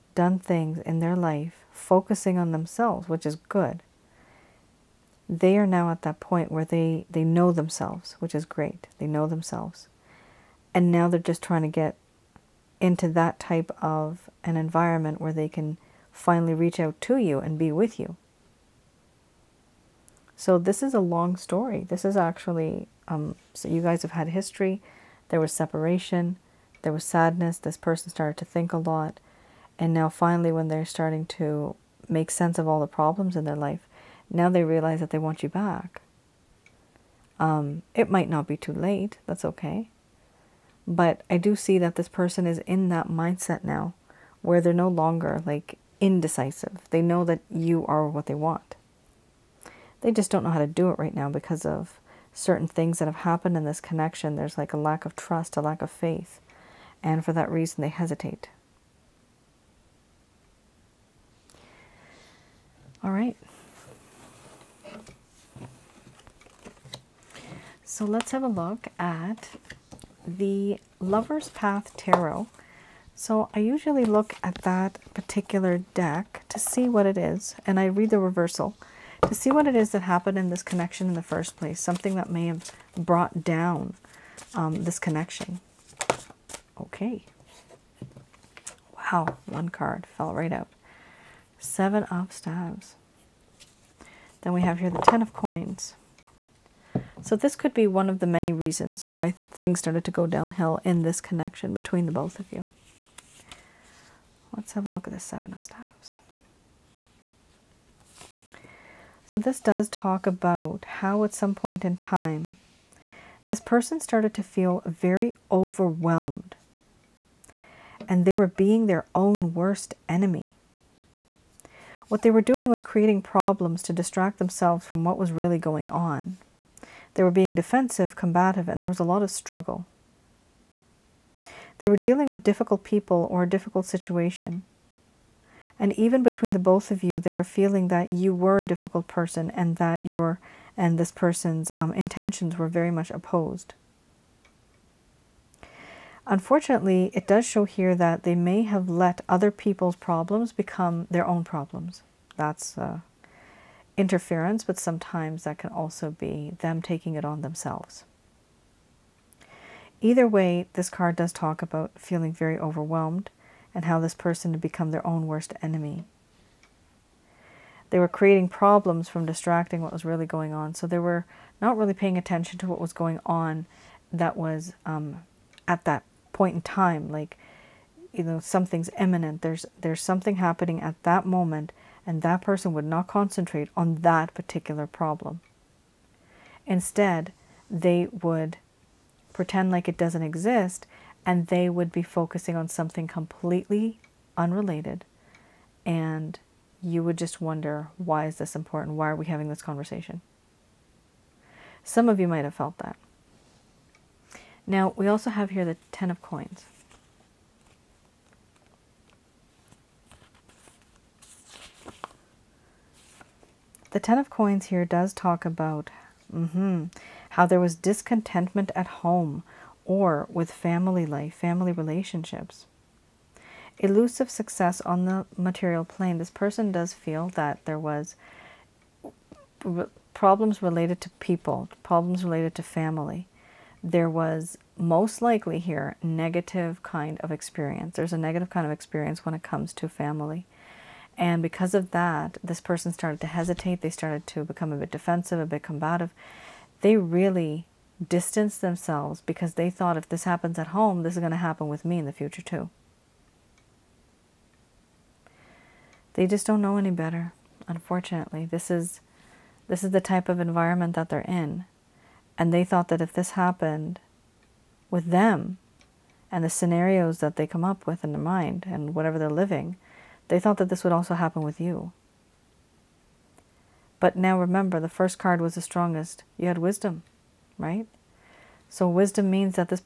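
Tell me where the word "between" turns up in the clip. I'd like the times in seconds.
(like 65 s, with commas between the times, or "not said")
101 s, 136 s.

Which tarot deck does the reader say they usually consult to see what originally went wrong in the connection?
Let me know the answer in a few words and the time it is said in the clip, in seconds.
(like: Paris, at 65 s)
Lover's Path Tarot, at 70 s.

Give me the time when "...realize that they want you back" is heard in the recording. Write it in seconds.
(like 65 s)
34 s.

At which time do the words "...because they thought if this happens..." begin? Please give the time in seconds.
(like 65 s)
249 s.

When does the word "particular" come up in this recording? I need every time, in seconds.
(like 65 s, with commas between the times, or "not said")
75 s, 184 s.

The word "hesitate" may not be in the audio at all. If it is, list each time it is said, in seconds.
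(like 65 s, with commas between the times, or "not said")
57 s, 243 s.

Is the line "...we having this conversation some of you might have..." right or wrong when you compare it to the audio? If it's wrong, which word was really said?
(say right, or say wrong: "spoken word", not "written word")
right.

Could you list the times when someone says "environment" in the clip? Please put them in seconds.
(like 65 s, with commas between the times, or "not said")
14 s, 260 s.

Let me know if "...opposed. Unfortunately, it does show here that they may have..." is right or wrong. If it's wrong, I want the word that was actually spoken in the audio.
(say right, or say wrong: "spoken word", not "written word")
right.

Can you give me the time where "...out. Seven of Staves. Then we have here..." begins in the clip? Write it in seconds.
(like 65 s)
90 s.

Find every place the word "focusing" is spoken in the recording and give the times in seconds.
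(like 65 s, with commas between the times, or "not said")
1 s, 192 s.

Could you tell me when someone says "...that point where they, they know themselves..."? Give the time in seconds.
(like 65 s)
6 s.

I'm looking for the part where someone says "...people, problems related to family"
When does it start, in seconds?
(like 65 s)
231 s.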